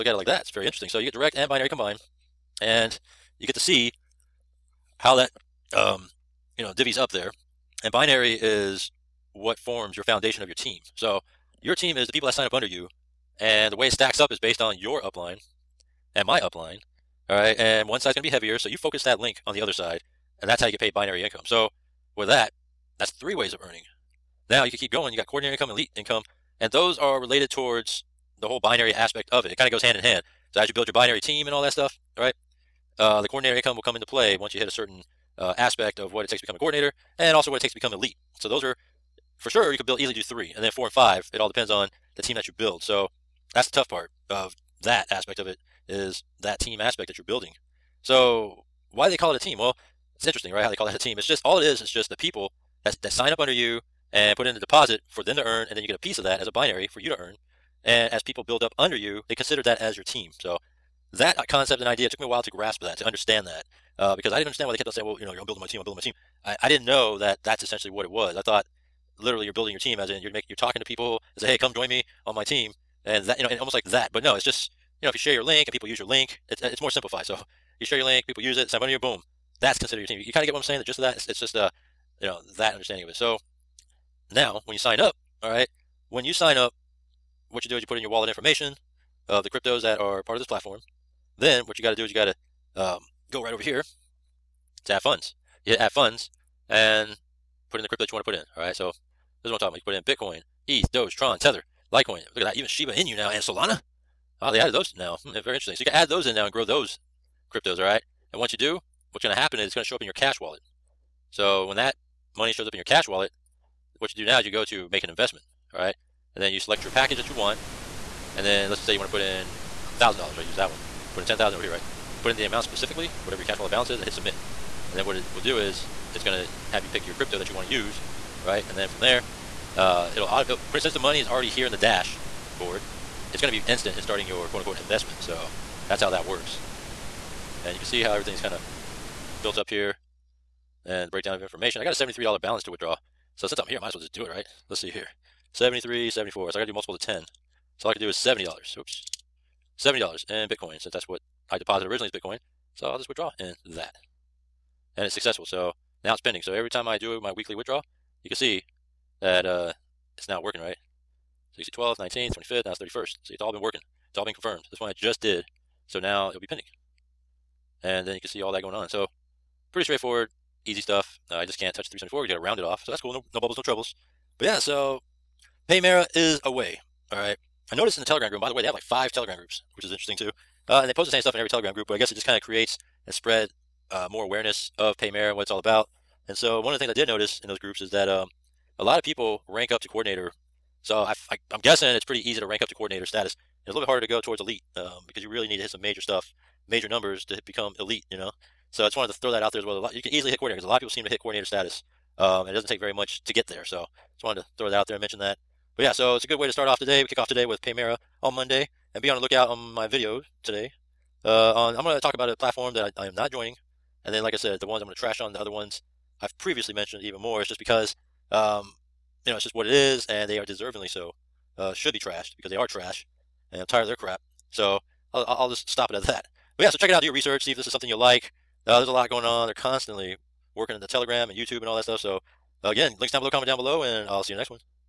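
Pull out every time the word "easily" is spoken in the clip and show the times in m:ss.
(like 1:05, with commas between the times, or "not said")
0:39, 3:20.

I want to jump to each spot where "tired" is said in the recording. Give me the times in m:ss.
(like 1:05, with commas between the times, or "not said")
3:43.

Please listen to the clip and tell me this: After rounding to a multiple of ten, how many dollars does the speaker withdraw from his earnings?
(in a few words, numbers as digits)
$70.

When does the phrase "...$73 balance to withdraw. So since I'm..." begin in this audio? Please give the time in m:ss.
2:21.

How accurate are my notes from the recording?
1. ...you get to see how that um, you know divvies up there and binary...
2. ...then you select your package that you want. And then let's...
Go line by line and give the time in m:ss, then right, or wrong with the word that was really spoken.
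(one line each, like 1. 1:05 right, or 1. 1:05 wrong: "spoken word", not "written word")
1. 0:03 right
2. 1:56 right.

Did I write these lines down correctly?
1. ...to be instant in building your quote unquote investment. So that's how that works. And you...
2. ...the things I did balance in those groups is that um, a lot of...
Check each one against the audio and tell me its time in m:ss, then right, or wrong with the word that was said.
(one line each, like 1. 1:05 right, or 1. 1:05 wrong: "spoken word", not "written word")
1. 2:13 wrong: "starting", not "building"
2. 3:06 wrong: "notice", not "balance".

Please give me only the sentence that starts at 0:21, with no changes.
So, with that, that's three ways of earning.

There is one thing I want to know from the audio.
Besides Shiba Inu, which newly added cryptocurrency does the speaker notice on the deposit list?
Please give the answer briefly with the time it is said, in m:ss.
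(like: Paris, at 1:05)
Solana, at 1:43.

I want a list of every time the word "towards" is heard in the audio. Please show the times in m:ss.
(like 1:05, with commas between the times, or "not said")
0:27, 3:14.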